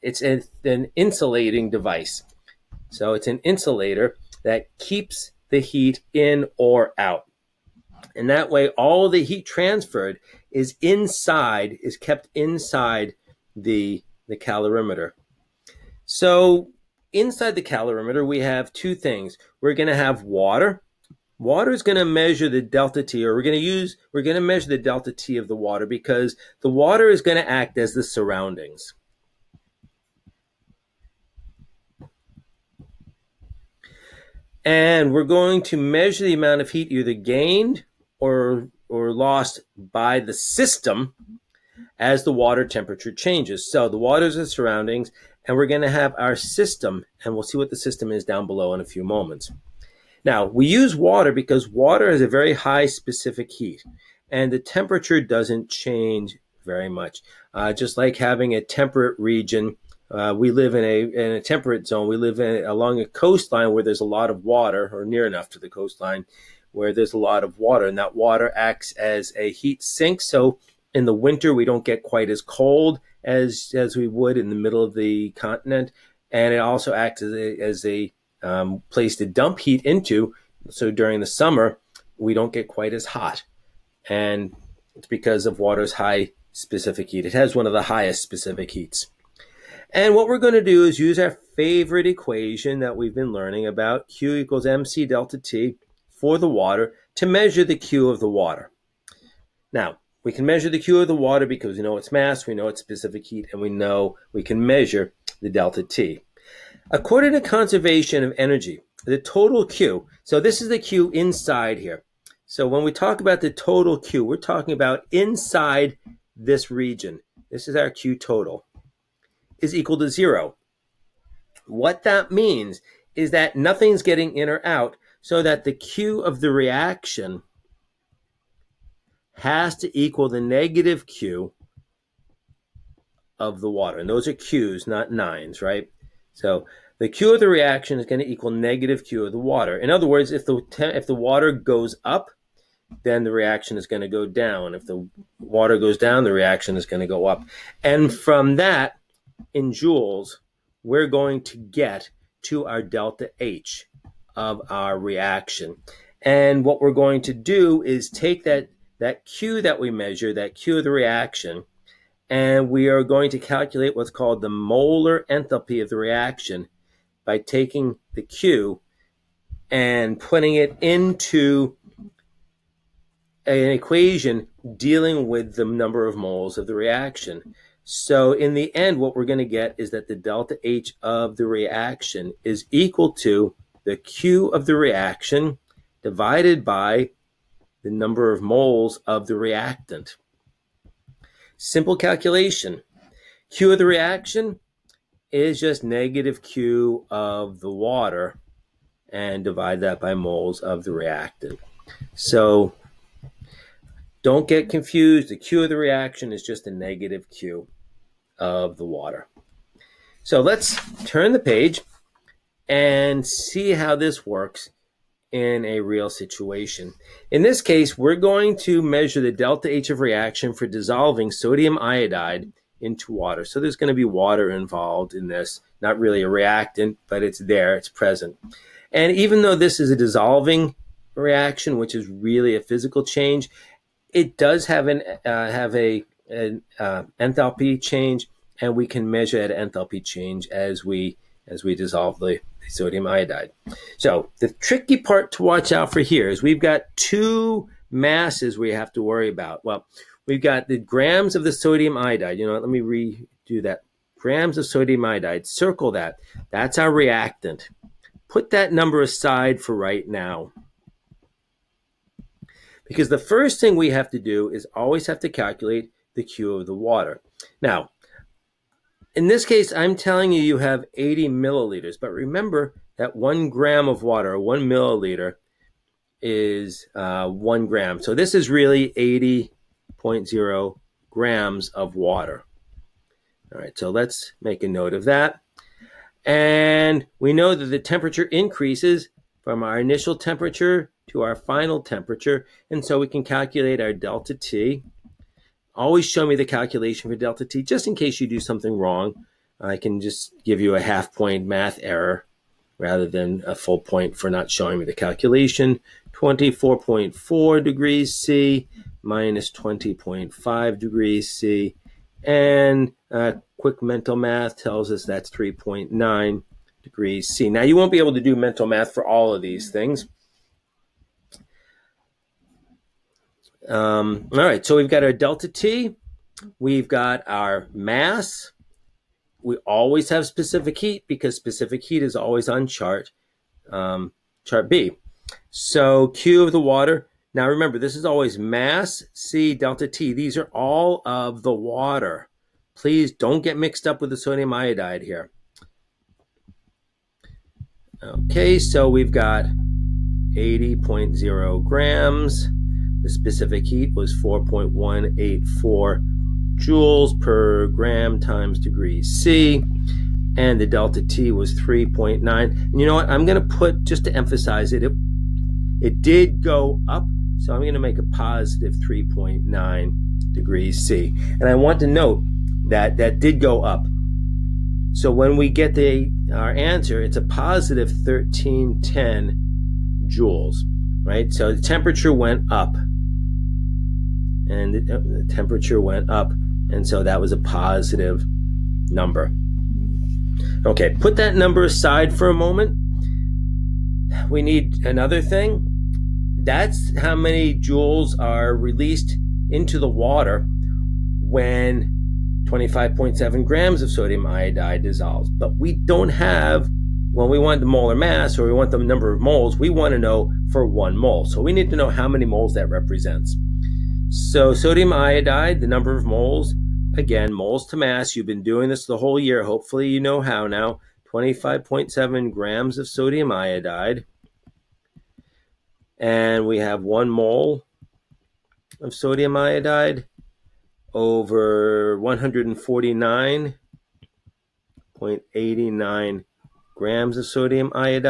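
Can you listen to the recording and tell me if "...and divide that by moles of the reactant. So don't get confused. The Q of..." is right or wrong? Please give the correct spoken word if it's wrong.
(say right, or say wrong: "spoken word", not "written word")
right.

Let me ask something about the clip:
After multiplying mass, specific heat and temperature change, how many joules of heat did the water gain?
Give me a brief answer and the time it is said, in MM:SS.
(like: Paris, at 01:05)
1310 joules, at 06:17.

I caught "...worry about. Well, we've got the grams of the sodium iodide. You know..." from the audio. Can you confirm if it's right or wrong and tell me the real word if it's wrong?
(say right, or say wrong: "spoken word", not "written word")
right.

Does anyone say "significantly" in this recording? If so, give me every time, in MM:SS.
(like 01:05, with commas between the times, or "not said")
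not said.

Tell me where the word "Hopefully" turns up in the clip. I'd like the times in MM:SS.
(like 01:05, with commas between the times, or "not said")
06:59.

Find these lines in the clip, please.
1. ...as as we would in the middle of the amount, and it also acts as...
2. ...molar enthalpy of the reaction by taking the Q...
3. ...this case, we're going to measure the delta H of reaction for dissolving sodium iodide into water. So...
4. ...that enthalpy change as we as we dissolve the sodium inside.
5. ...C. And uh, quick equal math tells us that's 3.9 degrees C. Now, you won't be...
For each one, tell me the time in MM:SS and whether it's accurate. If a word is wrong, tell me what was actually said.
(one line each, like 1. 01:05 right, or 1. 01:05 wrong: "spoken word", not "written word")
1. 01:13 wrong: "continent", not "amount"
2. 02:44 right
3. 03:37 right
4. 03:59 wrong: "iodide", not "inside"
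5. 05:11 wrong: "mental", not "equal".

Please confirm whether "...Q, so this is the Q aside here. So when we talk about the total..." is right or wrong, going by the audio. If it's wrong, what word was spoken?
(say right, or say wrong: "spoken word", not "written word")
wrong: "inside", not "aside".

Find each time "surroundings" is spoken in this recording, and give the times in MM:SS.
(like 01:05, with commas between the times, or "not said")
00:28, 00:44.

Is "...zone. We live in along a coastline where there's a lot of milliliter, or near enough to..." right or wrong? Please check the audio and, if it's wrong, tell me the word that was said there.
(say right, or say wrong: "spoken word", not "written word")
wrong: "water", not "milliliter".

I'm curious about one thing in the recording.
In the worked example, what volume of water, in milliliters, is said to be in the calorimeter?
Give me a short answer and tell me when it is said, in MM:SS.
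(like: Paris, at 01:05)
80, at 04:30.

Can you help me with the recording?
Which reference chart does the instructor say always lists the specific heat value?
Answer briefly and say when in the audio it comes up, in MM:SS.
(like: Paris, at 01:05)
chart B, at 05:34.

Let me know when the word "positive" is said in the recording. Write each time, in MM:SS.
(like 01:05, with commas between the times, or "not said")
06:08, 06:17, 06:27.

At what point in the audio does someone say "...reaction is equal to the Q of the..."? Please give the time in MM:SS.
03:01.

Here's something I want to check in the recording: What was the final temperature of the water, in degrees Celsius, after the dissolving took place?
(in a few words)
24.4.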